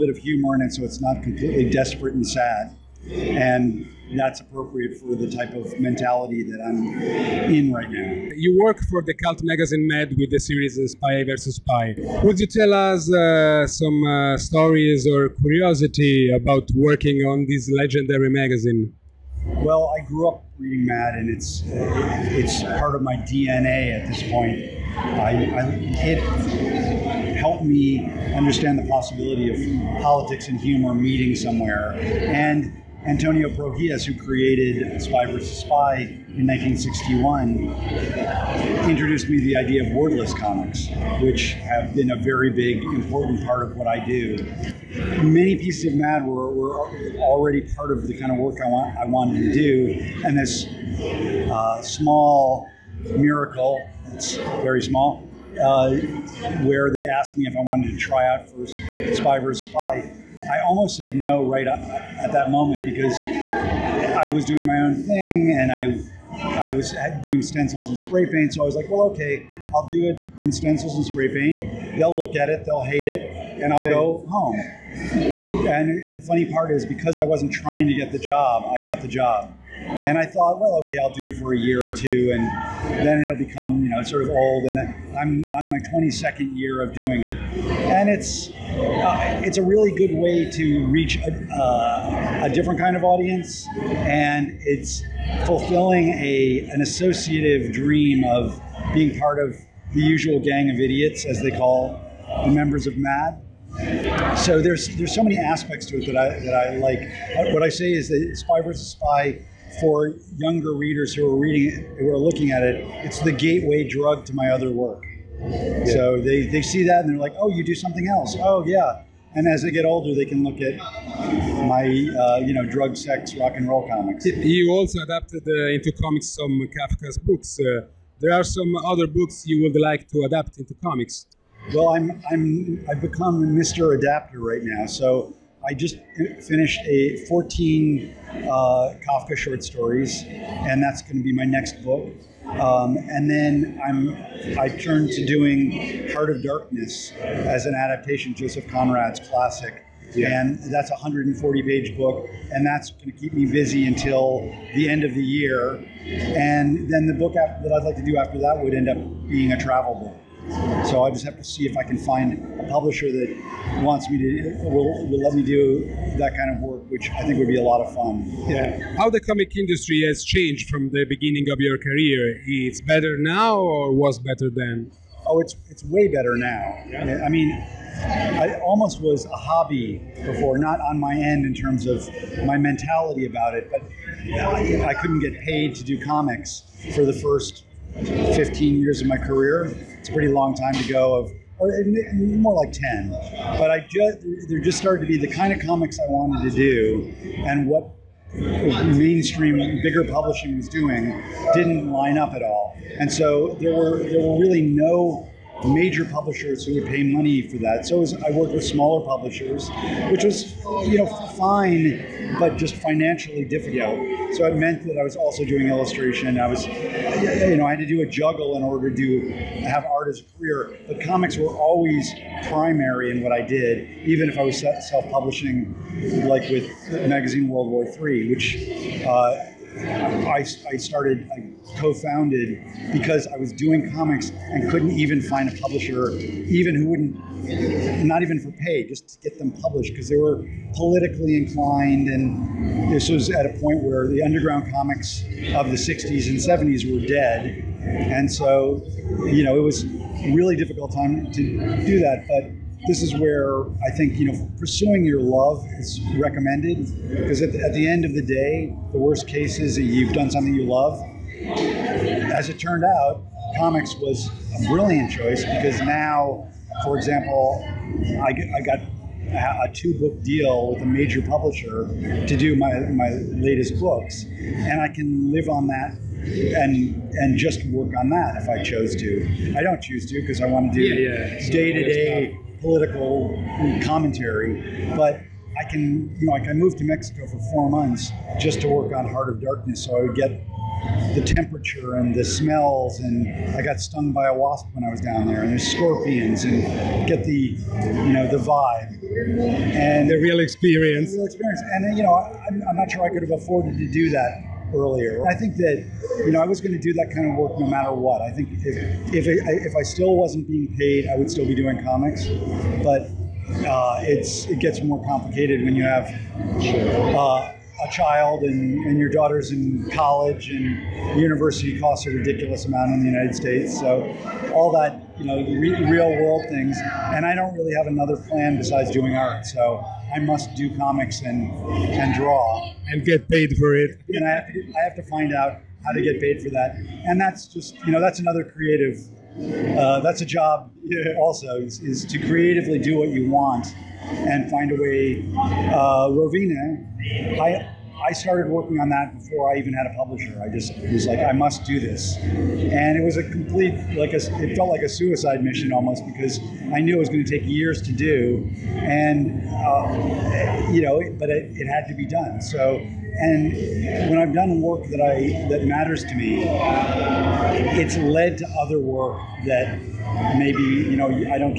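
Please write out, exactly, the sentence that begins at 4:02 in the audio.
And this was at a point where the underground comics of the 60s and 70s were dead.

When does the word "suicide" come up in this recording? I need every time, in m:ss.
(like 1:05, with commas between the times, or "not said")
5:54.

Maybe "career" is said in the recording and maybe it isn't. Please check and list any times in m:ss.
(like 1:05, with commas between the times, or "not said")
2:51, 3:09, 3:40.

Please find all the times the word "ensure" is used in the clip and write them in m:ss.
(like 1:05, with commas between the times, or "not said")
not said.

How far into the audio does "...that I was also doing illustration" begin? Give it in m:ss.
3:34.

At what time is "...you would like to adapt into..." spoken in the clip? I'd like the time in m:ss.
2:09.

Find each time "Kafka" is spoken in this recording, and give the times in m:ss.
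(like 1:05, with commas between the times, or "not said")
2:06, 2:19.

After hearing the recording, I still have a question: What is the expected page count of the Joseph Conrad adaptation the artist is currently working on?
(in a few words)
140.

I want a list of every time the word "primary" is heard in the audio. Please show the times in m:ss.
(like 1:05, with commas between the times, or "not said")
3:42.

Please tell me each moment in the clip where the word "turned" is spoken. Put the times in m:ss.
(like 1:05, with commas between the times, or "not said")
2:24, 4:22.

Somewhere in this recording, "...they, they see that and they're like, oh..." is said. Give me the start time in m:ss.
1:56.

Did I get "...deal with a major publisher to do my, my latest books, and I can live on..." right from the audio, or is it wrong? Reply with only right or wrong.
right.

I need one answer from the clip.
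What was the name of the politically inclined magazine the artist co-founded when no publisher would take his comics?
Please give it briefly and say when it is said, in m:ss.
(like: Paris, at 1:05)
World War III, at 3:47.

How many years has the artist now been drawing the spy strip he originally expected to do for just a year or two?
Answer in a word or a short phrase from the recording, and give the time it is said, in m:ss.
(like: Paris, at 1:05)
22, at 1:25.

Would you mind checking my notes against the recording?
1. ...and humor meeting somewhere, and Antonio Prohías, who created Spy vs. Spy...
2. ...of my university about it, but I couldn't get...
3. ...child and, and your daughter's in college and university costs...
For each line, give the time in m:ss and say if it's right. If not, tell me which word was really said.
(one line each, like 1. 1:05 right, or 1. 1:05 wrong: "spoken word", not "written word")
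1. 0:30 right
2. 3:01 wrong: "mentality", not "university"
3. 5:17 right.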